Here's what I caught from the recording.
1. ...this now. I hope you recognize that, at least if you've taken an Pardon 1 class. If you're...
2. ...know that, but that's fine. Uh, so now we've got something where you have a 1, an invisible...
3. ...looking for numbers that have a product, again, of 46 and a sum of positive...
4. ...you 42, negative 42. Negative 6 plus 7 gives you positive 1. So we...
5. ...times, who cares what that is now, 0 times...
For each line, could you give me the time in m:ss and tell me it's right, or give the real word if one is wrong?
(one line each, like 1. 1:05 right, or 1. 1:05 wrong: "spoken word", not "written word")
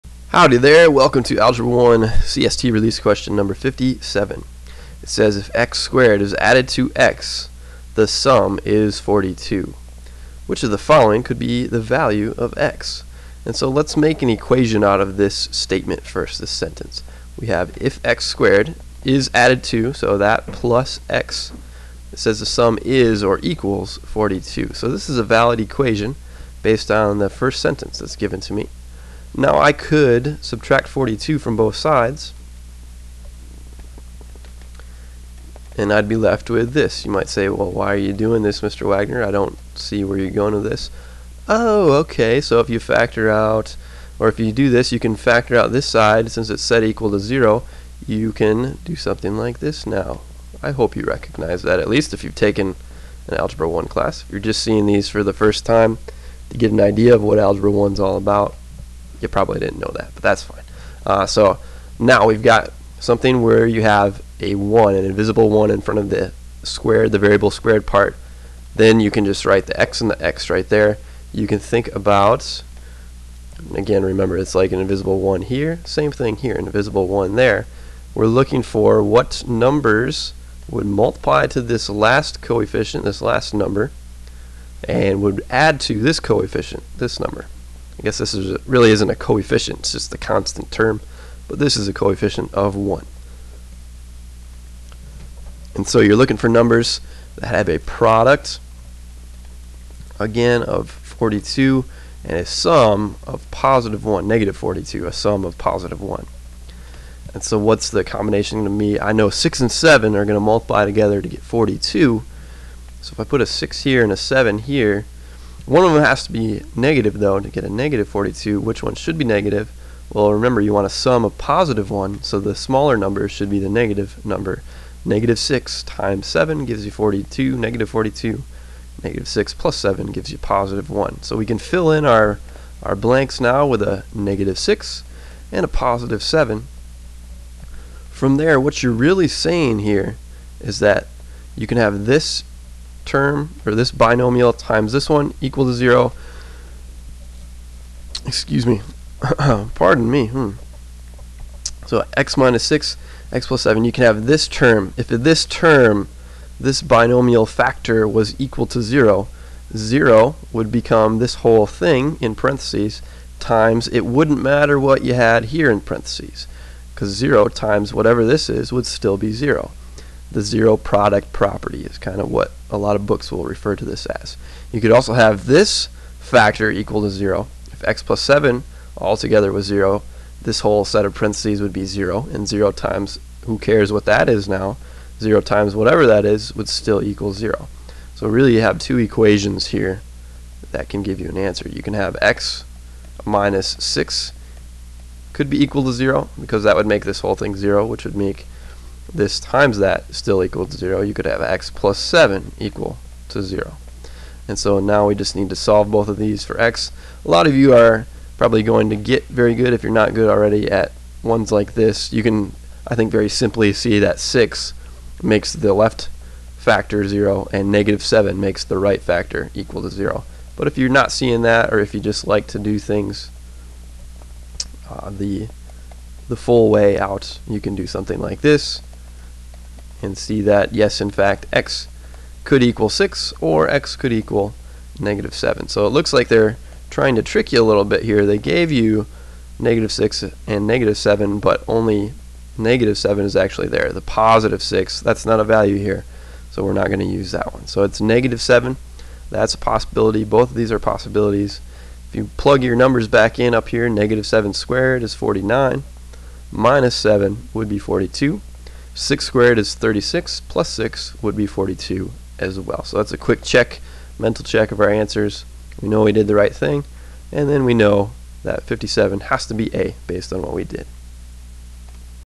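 1. 0:49 wrong: "Algebra", not "Pardon"
2. 0:59 right
3. 1:36 wrong: "42", not "46"
4. 2:06 right
5. 3:02 right.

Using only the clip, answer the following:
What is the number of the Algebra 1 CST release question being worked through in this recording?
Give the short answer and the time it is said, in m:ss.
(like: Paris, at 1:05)
57, at 0:03.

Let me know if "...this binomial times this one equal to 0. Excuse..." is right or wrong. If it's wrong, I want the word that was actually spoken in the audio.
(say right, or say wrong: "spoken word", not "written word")
right.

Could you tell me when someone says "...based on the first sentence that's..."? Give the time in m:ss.
0:26.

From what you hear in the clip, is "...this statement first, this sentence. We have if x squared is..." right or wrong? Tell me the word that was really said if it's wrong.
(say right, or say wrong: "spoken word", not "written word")
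right.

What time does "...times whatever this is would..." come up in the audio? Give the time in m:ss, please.
2:47.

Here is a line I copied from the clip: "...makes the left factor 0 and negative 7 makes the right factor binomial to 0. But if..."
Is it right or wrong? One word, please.
wrong.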